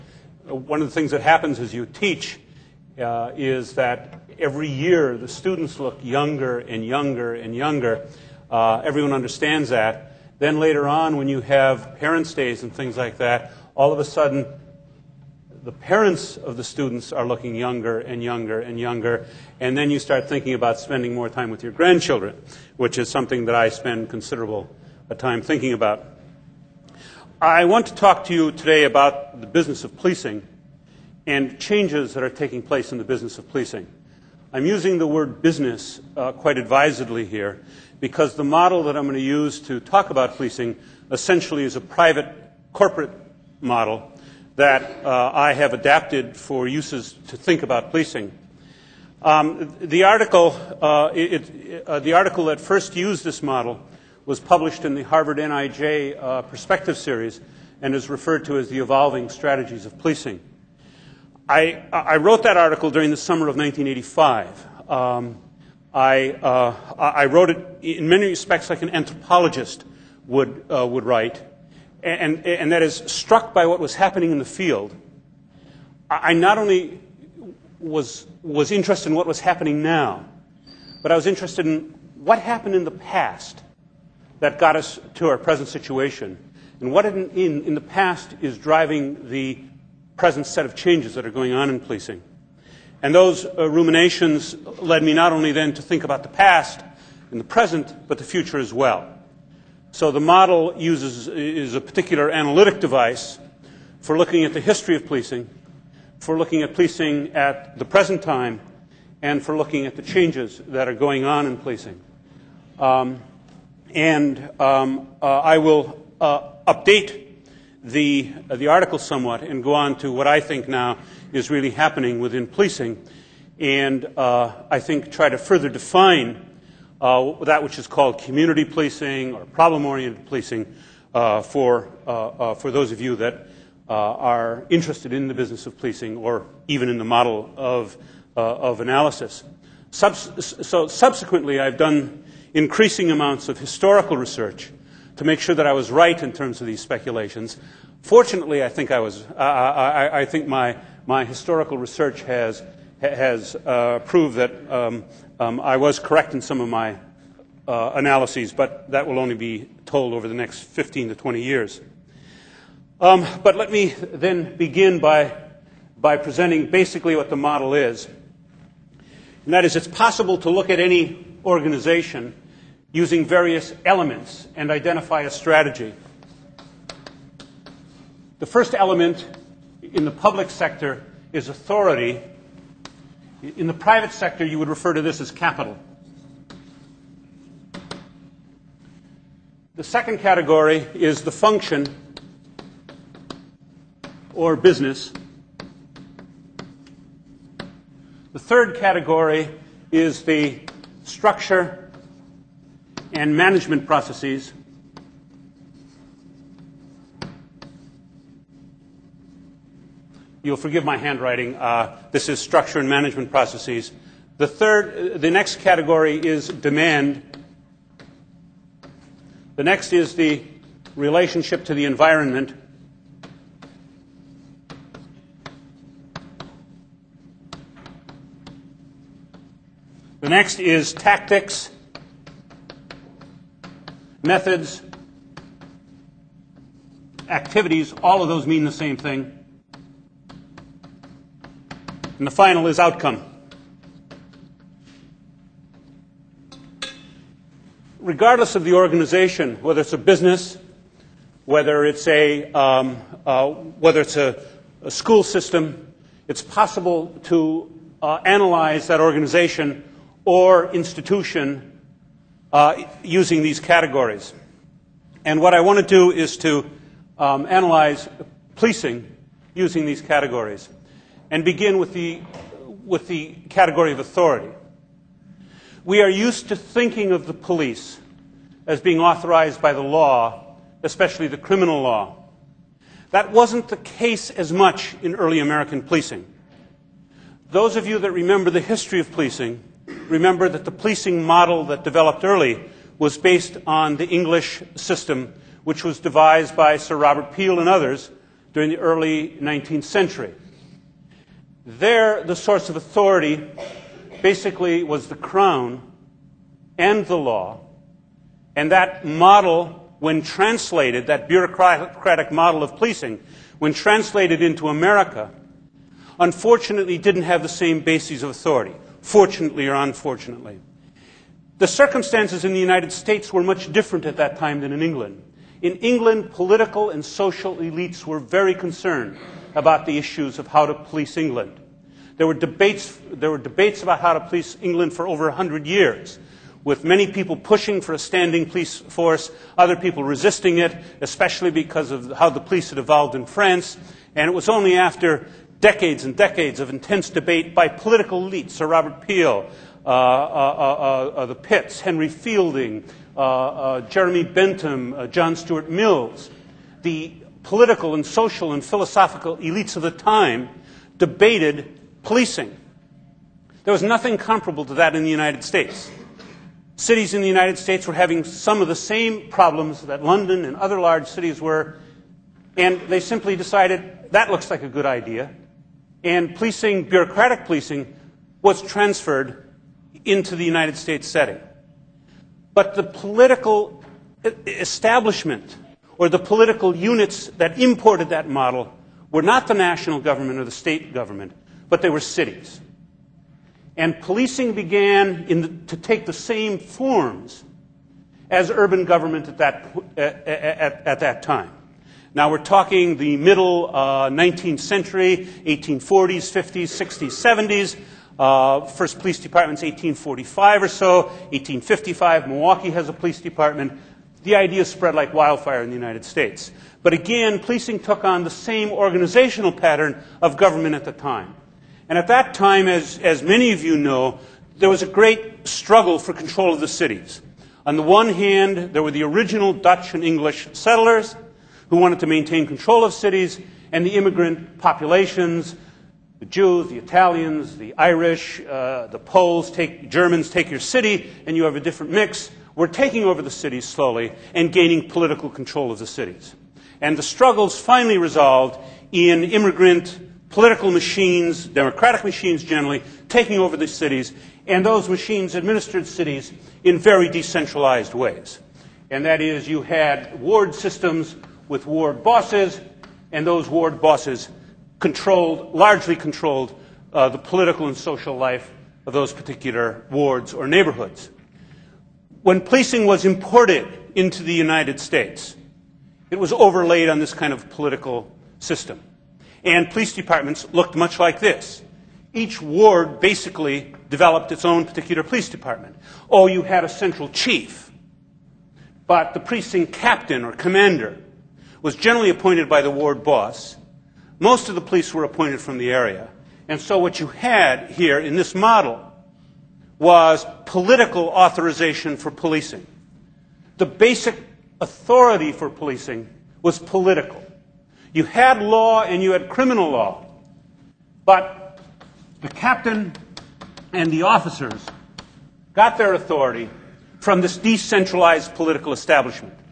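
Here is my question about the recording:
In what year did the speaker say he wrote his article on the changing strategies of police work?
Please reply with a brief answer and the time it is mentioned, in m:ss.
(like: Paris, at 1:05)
1985, at 1:03.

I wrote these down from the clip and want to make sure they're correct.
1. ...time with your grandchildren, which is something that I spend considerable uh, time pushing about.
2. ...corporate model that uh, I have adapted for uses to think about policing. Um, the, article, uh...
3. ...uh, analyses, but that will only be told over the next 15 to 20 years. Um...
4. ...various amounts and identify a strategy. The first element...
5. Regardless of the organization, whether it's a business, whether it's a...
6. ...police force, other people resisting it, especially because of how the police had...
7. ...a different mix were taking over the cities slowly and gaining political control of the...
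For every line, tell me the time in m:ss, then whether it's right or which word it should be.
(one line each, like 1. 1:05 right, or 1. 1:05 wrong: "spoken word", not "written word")
1. 0:21 wrong: "thinking", not "pushing"
2. 0:42 right
3. 2:37 right
4. 2:53 wrong: "elements", not "amounts"
5. 4:07 right
6. 5:38 right
7. 7:21 right.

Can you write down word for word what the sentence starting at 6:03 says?
There was nothing comparable to that in the United States.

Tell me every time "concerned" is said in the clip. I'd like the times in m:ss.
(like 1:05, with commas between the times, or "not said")
5:28.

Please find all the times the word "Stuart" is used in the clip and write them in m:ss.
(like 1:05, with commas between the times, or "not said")
5:55.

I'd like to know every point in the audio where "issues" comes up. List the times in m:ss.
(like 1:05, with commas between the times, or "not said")
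5:29.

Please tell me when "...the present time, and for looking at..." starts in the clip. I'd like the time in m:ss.
1:47.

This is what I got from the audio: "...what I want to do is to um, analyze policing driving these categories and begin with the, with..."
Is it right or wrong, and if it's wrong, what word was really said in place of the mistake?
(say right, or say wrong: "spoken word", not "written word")
wrong: "using", not "driving".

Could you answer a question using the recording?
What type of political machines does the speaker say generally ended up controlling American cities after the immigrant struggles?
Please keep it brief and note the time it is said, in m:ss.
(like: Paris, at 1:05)
democratic machines, at 7:31.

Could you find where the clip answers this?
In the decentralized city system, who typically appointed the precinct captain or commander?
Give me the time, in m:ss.
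8:12.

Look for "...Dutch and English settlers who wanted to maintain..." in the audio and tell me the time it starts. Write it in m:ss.
7:09.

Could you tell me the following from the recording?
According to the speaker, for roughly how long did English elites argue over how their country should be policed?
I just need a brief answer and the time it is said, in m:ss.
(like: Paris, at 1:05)
over 100 years, at 5:35.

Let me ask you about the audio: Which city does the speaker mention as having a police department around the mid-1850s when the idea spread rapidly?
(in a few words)
Milwaukee.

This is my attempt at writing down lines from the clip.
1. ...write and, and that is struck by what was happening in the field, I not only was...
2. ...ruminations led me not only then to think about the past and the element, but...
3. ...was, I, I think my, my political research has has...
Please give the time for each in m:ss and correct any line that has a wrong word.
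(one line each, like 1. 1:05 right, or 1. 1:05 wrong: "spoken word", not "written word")
1. 1:11 right
2. 1:33 wrong: "present", not "element"
3. 2:28 wrong: "historical", not "political".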